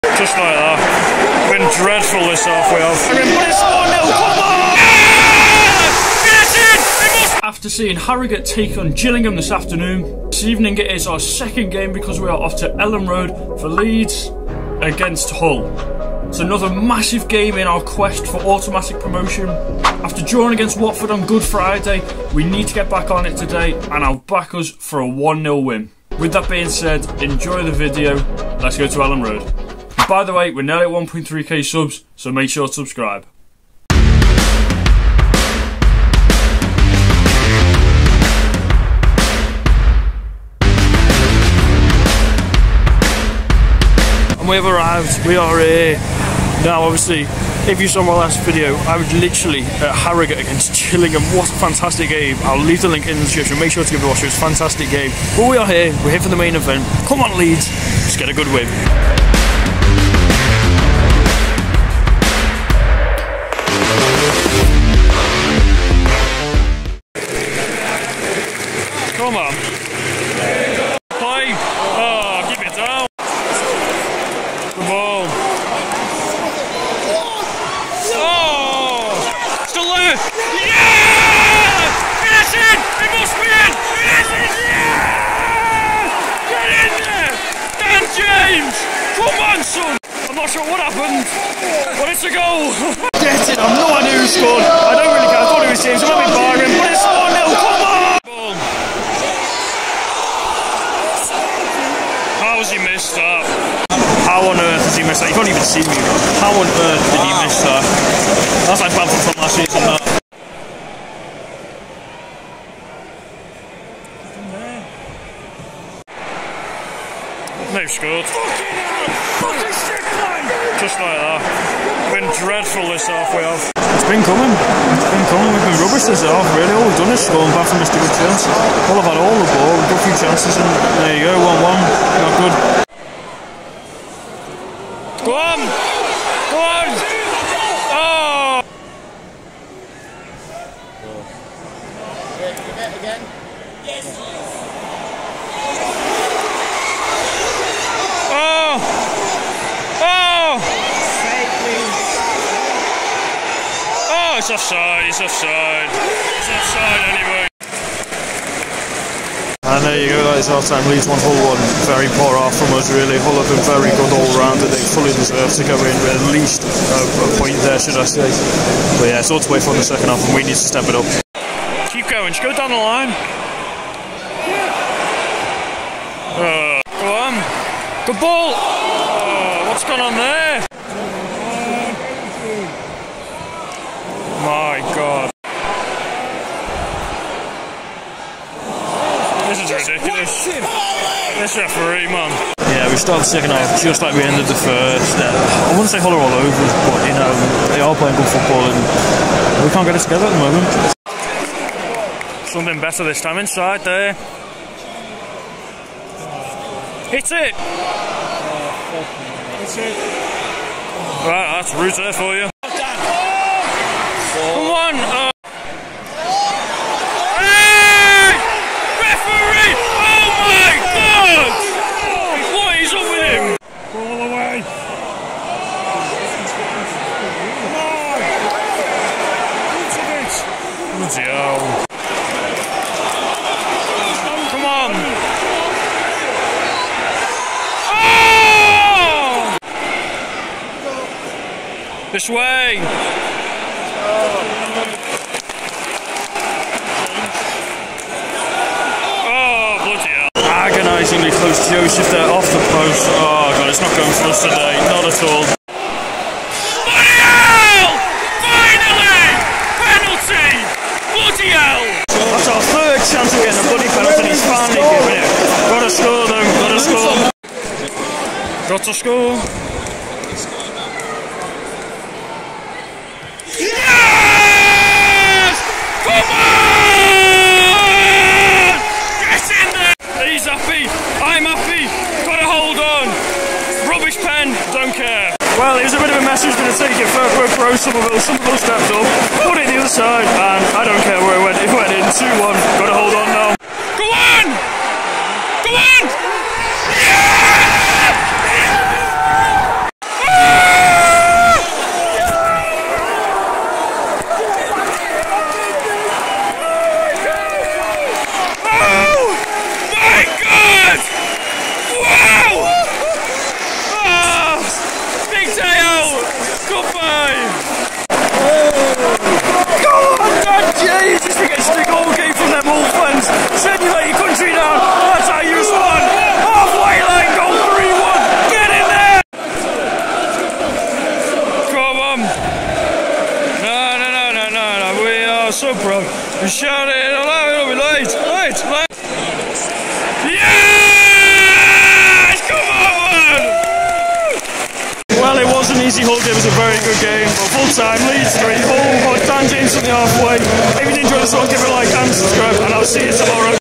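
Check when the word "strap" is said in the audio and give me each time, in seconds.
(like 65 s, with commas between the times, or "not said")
not said.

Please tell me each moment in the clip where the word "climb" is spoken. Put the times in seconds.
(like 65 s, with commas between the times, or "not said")
not said.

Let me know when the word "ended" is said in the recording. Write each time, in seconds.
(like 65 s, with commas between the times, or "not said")
194 s.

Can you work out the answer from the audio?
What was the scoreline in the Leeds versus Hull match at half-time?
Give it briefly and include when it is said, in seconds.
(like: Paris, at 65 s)
1-1, at 160 s.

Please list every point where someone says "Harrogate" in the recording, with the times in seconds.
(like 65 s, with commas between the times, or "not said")
7 s, 49 s.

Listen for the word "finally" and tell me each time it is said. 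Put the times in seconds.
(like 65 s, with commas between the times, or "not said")
256 s, 264 s.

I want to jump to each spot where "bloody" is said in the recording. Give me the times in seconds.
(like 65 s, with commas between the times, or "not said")
249 s, 263 s.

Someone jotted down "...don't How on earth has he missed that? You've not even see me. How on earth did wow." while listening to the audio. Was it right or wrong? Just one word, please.
right.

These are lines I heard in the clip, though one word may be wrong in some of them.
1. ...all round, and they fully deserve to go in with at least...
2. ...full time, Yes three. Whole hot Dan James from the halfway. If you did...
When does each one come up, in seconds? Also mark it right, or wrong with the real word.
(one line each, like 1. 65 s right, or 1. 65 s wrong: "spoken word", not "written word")
1. 164 s right
2. 347 s wrong: "Leeds", not "Yes".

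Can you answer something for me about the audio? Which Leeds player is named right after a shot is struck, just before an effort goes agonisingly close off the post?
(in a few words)
Rutter.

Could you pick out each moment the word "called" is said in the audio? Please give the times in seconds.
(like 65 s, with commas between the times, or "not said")
not said.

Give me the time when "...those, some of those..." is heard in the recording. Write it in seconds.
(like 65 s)
288 s.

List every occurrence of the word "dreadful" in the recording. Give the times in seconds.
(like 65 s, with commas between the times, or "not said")
1 s, 122 s.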